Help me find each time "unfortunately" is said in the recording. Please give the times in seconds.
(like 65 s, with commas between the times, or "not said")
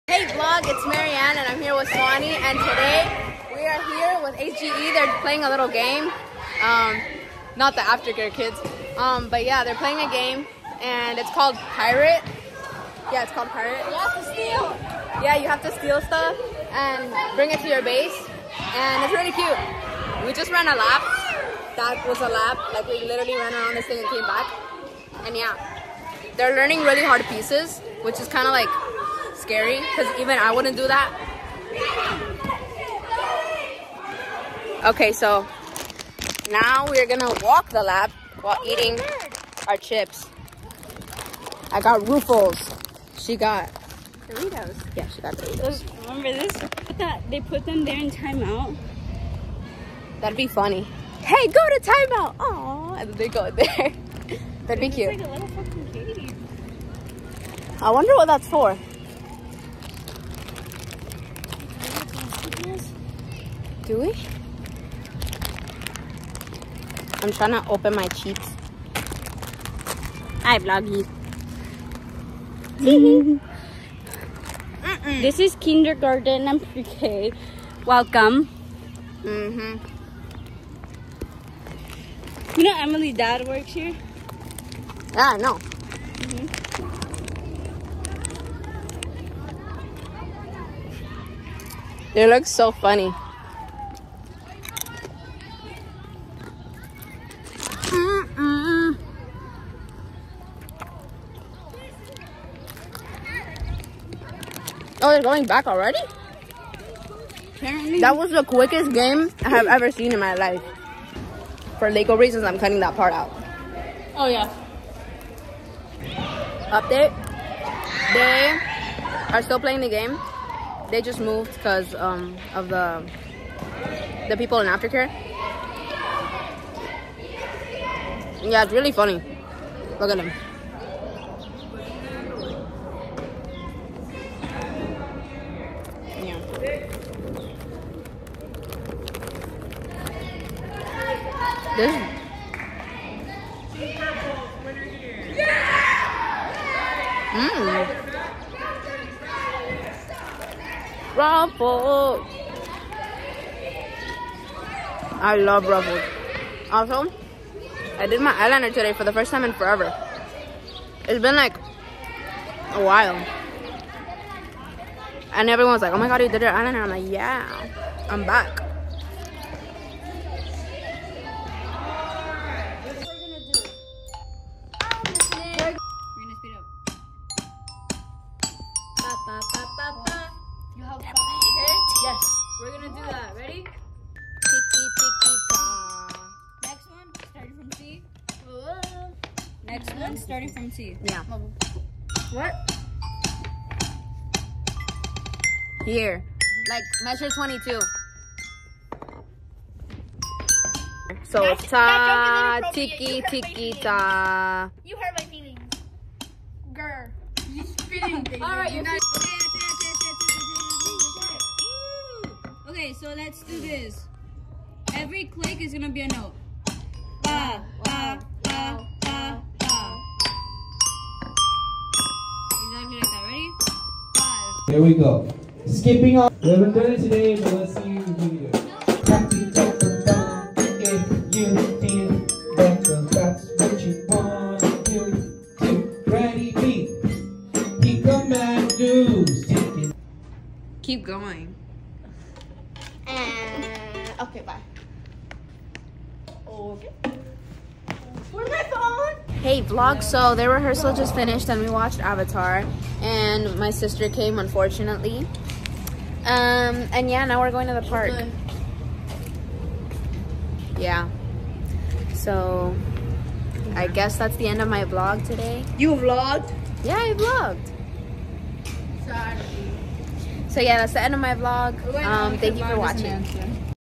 254 s.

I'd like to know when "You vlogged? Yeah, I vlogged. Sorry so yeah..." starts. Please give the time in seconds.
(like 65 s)
265 s.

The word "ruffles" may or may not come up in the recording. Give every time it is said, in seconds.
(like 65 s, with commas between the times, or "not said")
42 s, 151 s, 155 s.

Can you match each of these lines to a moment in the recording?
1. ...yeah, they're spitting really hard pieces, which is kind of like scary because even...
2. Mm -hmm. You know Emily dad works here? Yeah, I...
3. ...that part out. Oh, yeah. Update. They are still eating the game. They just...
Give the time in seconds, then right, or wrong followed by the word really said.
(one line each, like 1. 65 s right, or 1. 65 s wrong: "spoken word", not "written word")
1. 25 s wrong: "learning", not "spitting"
2. 79 s right
3. 112 s wrong: "playing", not "eating".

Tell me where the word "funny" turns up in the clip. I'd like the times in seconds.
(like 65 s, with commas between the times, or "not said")
50 s, 92 s, 128 s.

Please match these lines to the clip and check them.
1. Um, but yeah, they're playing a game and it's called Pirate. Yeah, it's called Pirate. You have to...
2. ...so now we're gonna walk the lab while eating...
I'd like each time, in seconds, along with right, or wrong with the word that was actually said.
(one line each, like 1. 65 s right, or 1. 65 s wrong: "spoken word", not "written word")
1. 8 s right
2. 35 s right.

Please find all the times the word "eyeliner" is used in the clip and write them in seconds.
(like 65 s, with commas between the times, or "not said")
158 s, 166 s.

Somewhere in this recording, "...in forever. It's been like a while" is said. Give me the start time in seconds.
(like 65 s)
159 s.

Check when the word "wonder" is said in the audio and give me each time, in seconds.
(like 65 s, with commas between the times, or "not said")
57 s.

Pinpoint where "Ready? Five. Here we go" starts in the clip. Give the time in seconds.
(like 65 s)
223 s.